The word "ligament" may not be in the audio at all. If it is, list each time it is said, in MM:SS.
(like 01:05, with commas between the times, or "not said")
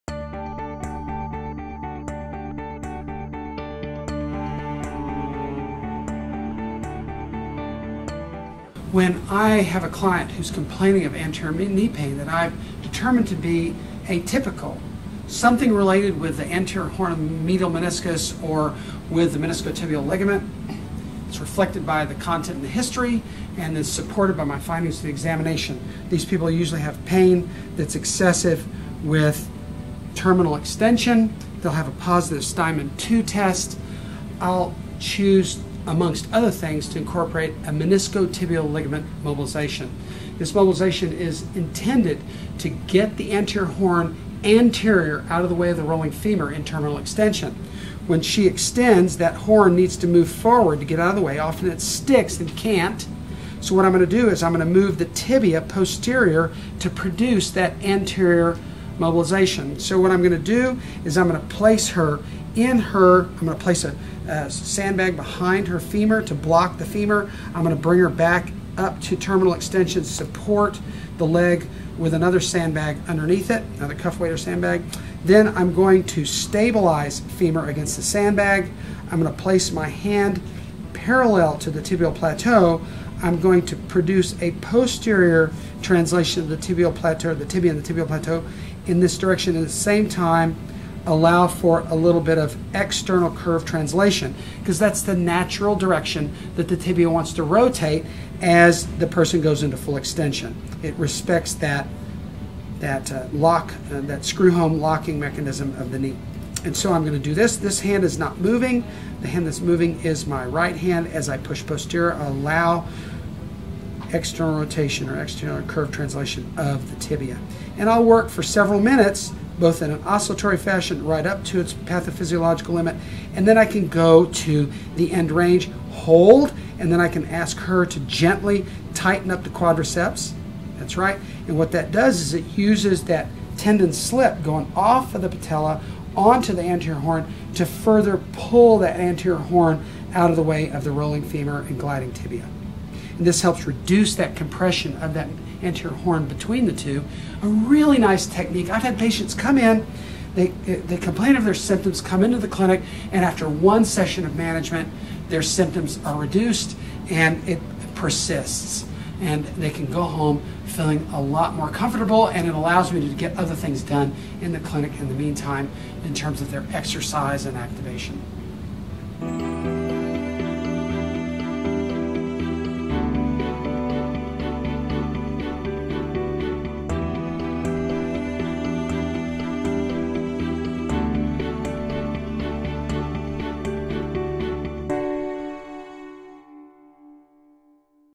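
00:20, 00:38.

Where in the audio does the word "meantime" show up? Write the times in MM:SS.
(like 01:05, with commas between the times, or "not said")
02:45.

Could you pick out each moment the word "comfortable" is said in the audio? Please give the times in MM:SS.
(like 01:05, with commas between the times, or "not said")
02:41.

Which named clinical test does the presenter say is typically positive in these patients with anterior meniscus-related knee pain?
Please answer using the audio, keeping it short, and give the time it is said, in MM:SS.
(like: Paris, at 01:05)
Steinmann 2 test, at 00:32.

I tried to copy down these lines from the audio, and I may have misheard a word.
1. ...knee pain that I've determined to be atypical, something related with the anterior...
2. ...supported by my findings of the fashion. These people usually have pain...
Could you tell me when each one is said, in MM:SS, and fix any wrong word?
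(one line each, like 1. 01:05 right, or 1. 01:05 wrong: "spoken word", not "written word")
1. 00:11 right
2. 00:23 wrong: "examination", not "fashion".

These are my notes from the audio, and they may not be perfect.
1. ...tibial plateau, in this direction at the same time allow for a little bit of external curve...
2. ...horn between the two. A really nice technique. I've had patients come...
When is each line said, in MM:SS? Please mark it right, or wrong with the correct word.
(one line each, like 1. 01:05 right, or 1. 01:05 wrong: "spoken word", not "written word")
1. 01:27 right
2. 02:25 right.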